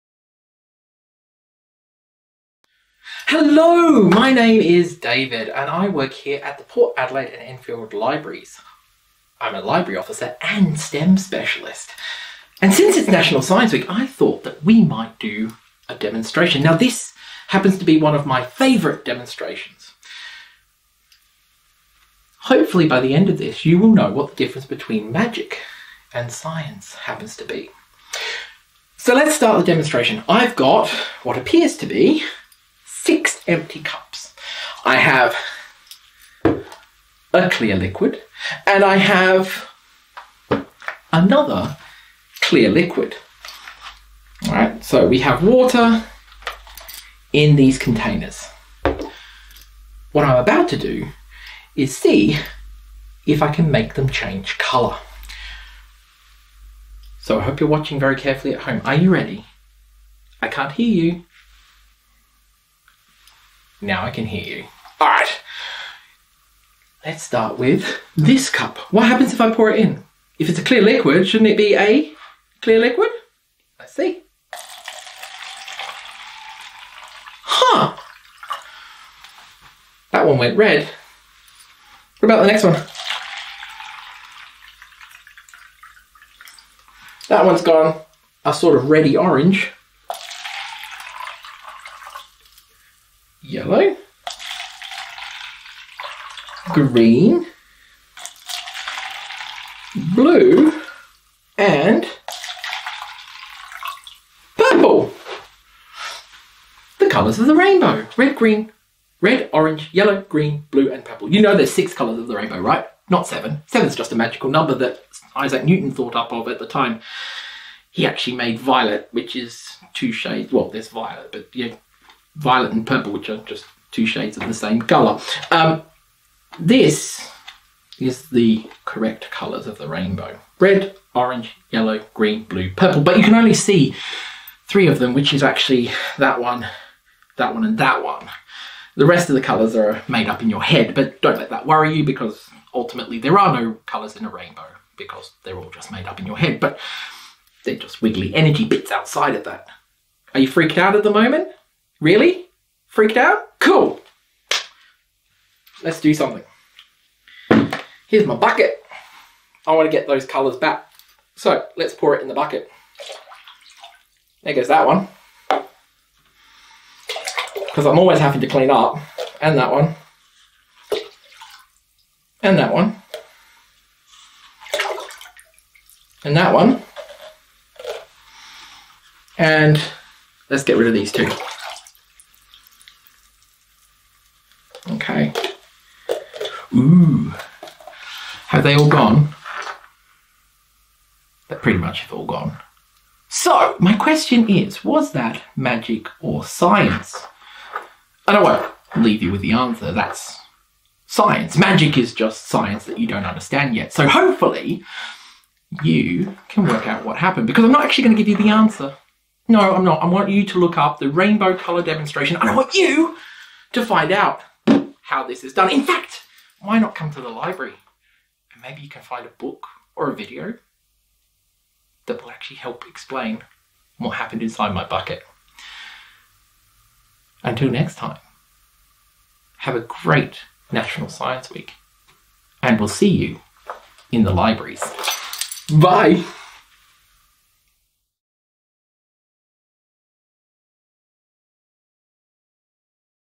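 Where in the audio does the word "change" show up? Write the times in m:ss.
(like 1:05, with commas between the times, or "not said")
0:54.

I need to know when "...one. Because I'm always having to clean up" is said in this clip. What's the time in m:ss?
2:44.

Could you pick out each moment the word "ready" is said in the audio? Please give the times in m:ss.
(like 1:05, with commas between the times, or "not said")
0:59, 1:28.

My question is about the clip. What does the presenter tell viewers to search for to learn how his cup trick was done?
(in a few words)
Rainbow color demonstration.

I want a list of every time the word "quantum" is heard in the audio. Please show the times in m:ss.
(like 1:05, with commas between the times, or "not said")
not said.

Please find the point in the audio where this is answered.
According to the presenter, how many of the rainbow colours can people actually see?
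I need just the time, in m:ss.
2:14.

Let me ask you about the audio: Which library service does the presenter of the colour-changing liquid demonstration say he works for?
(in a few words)
Port Adelaide and Enfield Libraries.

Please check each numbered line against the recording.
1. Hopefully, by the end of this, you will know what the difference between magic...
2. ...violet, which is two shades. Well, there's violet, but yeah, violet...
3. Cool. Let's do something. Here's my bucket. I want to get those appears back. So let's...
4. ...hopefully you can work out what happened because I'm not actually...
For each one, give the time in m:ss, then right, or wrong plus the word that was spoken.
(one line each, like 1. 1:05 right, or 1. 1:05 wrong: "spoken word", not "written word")
1. 0:22 right
2. 1:58 right
3. 2:33 wrong: "colours", not "appears"
4. 3:24 right.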